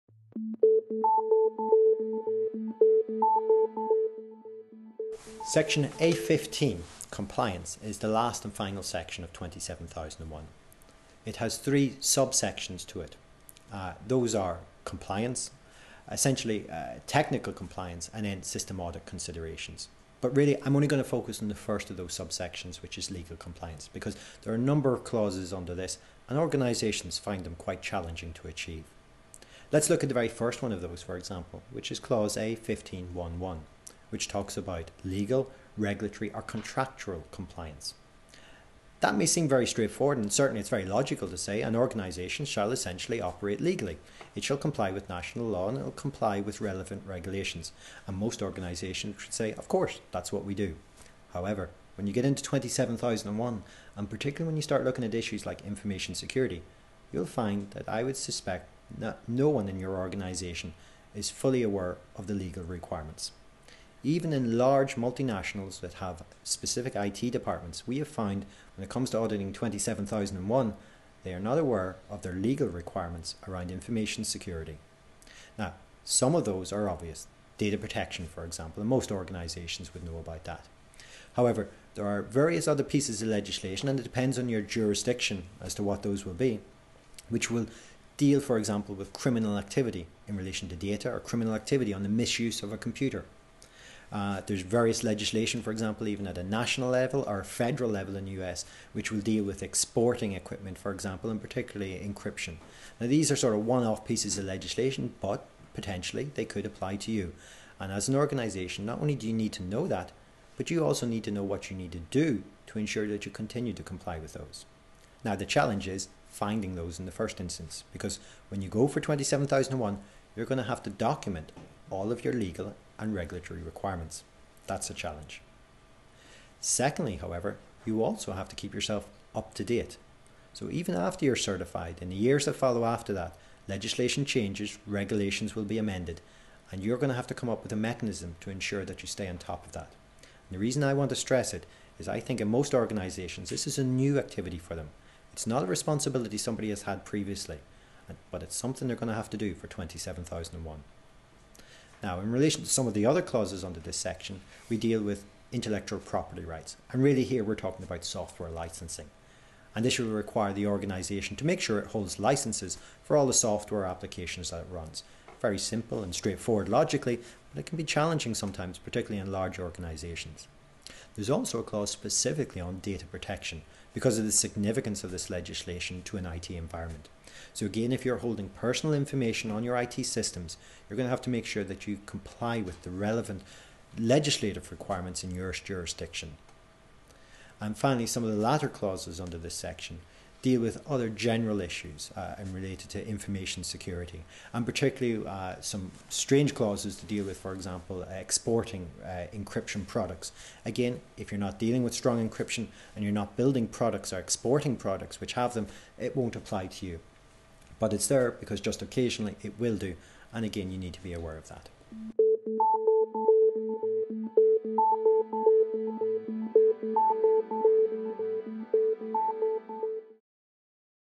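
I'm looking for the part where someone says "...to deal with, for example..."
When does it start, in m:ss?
3:16.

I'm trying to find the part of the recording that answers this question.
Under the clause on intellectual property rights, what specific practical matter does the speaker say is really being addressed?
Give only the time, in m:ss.
2:38.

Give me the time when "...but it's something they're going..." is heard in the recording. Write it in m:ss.
2:28.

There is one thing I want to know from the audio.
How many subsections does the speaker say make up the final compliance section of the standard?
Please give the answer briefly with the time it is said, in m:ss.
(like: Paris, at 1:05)
3, at 0:11.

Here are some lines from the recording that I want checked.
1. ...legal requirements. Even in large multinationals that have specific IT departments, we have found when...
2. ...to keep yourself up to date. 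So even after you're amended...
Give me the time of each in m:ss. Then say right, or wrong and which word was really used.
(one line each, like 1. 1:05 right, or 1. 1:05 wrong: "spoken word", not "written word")
1. 1:02 right
2. 2:08 wrong: "certified", not "amended".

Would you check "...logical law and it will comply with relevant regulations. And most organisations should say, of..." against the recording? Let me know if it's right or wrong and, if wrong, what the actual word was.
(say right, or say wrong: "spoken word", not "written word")
wrong: "national", not "logical".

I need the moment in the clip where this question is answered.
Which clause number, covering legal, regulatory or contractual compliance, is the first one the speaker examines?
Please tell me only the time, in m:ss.
0:32.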